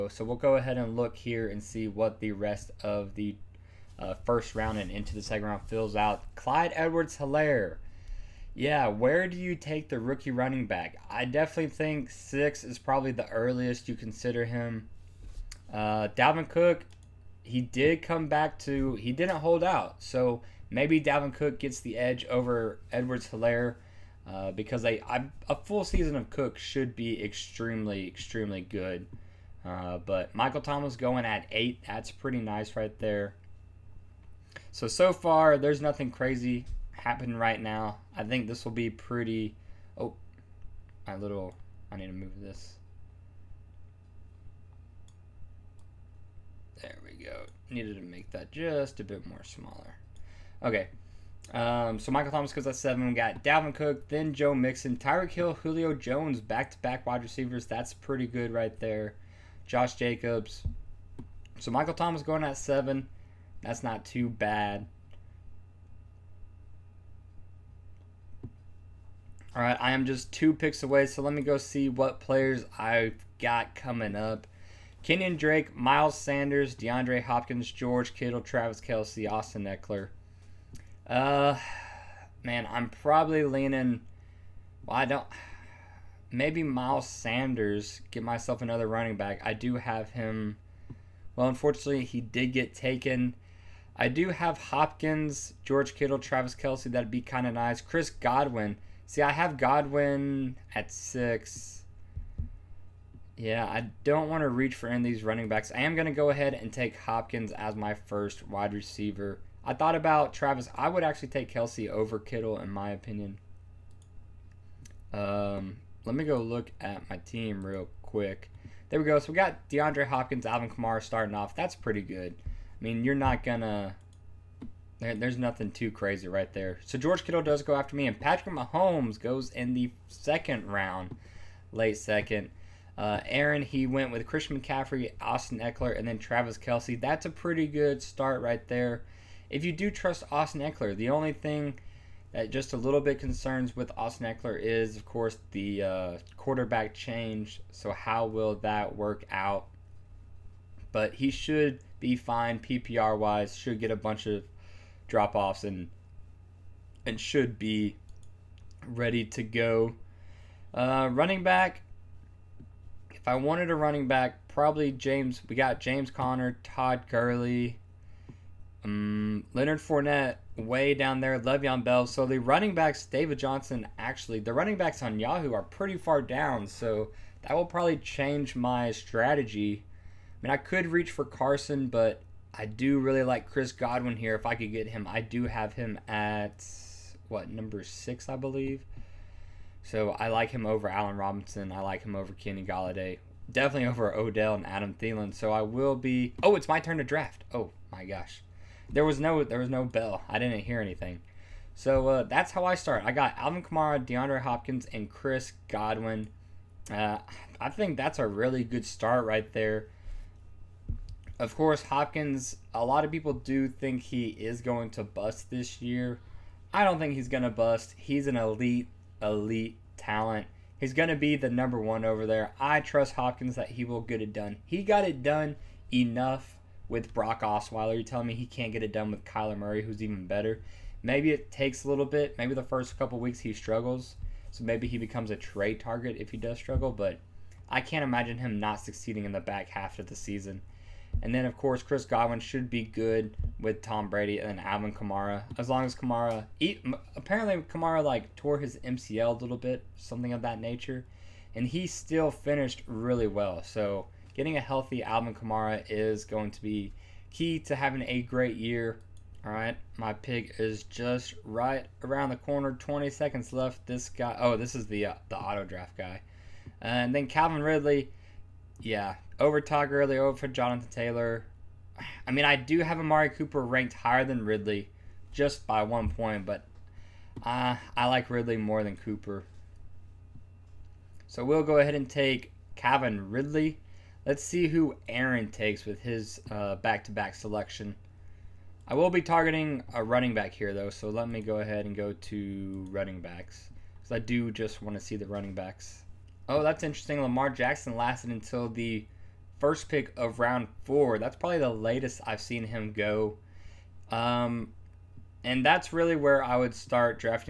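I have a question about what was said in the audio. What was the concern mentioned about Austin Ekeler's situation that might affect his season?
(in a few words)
quarterback change.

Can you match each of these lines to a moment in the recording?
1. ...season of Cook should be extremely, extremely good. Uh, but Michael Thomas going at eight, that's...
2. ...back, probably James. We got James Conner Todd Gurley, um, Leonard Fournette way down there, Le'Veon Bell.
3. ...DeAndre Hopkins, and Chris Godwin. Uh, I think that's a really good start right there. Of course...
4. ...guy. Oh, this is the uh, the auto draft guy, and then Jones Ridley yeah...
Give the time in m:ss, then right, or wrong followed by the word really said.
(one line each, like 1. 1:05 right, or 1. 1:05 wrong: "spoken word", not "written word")
1. 0:25 right
2. 2:44 right
3. 3:24 right
4. 4:24 wrong: "Calvin", not "Jones".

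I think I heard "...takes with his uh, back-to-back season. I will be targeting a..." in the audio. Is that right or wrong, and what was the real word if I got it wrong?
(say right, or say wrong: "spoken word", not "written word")
wrong: "selection", not "season".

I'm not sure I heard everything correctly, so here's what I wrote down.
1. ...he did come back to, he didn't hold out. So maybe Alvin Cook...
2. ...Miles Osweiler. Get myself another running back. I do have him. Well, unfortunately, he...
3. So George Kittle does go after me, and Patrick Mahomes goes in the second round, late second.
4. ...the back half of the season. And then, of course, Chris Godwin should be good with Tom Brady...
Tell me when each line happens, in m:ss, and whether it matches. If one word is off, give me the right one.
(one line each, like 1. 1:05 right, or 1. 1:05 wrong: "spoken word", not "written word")
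1. 0:17 wrong: "Dalvin", not "Alvin"
2. 1:26 wrong: "Sanders", not "Osweiler"
3. 2:06 right
4. 3:59 right.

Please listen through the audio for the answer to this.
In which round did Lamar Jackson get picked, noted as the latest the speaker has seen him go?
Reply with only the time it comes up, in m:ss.
5:00.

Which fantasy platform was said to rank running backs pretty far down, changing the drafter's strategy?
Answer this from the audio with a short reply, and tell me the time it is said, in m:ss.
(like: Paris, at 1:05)
Yahoo, at 2:55.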